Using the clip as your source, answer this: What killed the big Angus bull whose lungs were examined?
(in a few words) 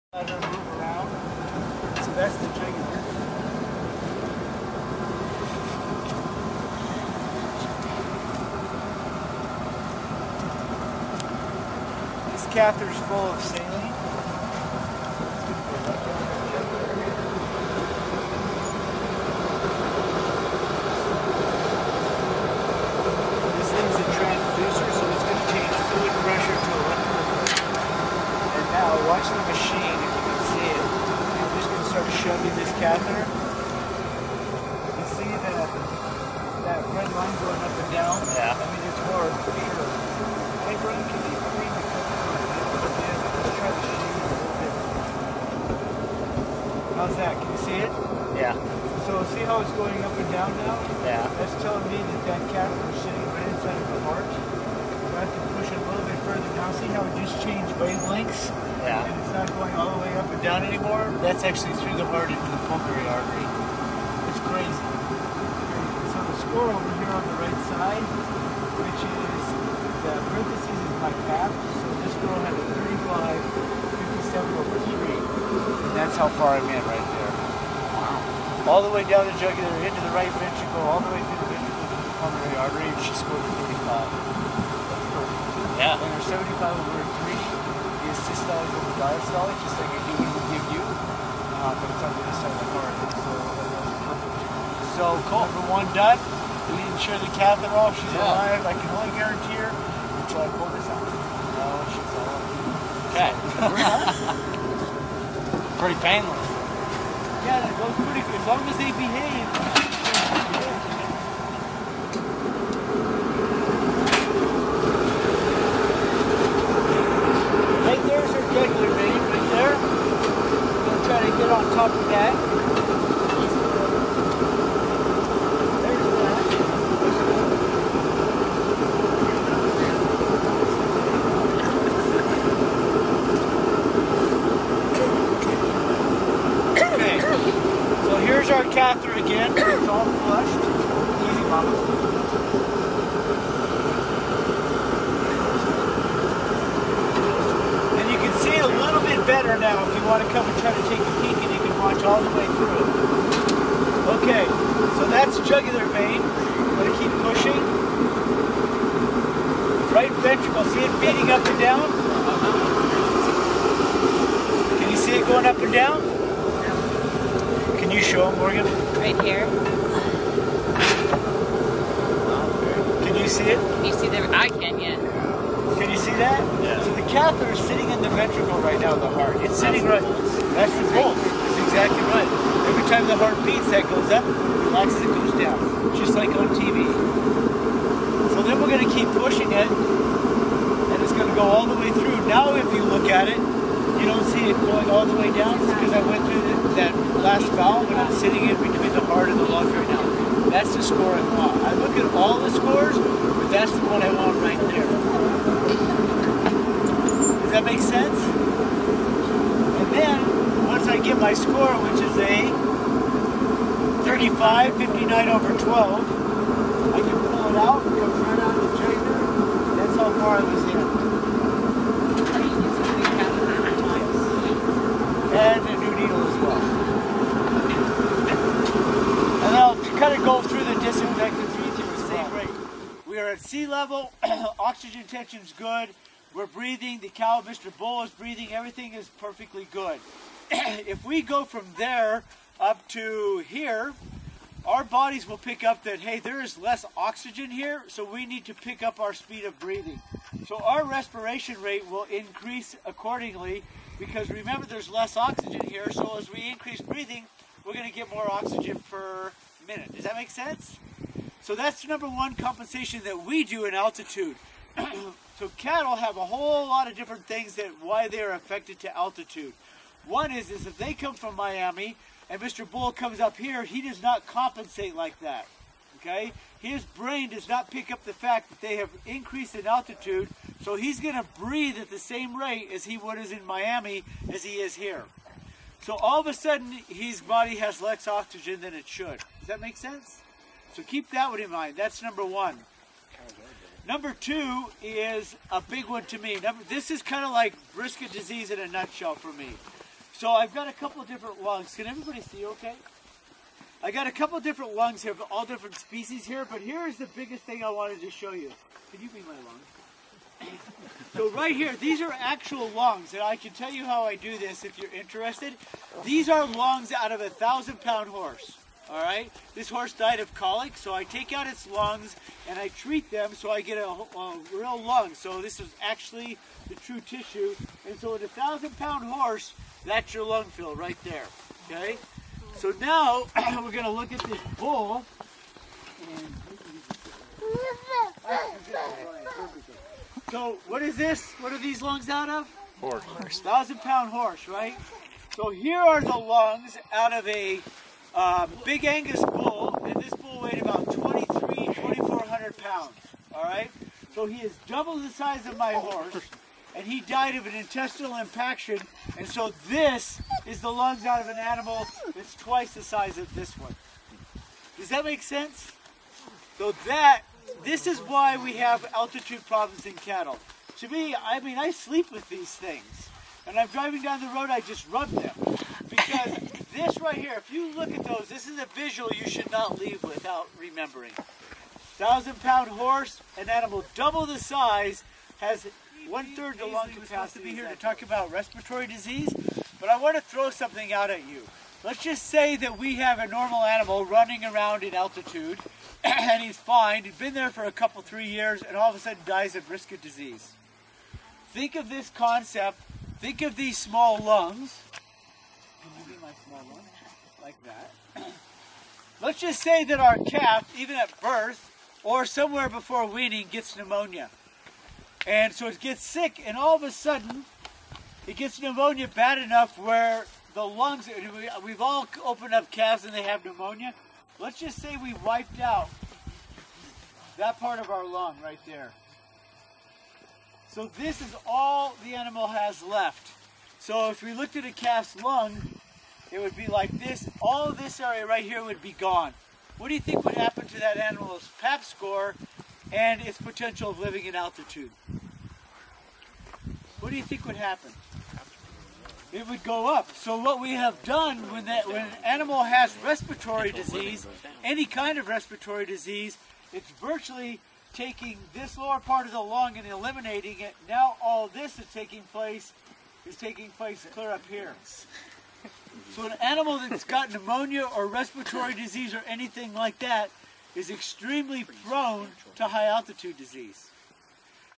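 Intestinal impaction.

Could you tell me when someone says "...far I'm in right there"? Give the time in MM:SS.
01:16.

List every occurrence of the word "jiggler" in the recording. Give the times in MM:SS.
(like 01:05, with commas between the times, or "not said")
00:02.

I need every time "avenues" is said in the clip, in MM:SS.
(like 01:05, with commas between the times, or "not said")
not said.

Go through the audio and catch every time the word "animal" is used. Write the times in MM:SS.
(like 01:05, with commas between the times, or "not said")
06:01, 06:23, 06:33, 07:12, 07:20, 07:32, 07:46.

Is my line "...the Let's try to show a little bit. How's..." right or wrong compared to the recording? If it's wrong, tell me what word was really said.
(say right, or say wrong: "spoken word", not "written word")
right.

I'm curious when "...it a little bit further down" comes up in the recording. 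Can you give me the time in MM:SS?
00:55.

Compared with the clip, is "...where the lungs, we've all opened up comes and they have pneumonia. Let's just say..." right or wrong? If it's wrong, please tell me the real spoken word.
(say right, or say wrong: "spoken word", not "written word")
wrong: "calves", not "comes".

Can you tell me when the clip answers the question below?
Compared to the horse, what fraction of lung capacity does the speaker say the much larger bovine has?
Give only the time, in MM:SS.
06:26.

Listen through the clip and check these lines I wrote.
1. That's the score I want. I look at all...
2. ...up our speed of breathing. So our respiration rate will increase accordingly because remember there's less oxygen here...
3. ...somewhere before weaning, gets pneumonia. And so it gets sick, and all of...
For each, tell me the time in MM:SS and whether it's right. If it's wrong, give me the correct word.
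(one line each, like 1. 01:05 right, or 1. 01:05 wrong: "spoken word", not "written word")
1. 03:20 right
2. 04:08 right
3. 06:52 right.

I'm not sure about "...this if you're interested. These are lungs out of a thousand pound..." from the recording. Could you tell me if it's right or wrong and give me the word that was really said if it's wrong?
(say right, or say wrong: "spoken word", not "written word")
right.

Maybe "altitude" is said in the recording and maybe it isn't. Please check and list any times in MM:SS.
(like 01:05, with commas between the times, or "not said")
04:23, 04:28, 04:39, 06:08, 06:34, 07:24, 07:52.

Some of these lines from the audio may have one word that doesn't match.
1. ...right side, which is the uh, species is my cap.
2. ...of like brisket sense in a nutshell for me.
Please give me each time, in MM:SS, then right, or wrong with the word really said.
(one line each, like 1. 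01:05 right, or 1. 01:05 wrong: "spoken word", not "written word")
1. 01:07 wrong: "parentheses", not "species"
2. 04:57 wrong: "disease", not "sense".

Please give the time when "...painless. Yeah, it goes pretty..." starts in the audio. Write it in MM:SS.
01:46.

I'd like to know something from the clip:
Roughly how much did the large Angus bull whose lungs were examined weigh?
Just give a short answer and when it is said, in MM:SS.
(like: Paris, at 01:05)
2,400 pounds, at 05:50.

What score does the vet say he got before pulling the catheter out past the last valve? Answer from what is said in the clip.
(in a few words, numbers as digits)
35.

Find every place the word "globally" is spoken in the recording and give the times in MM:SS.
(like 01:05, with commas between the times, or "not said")
not said.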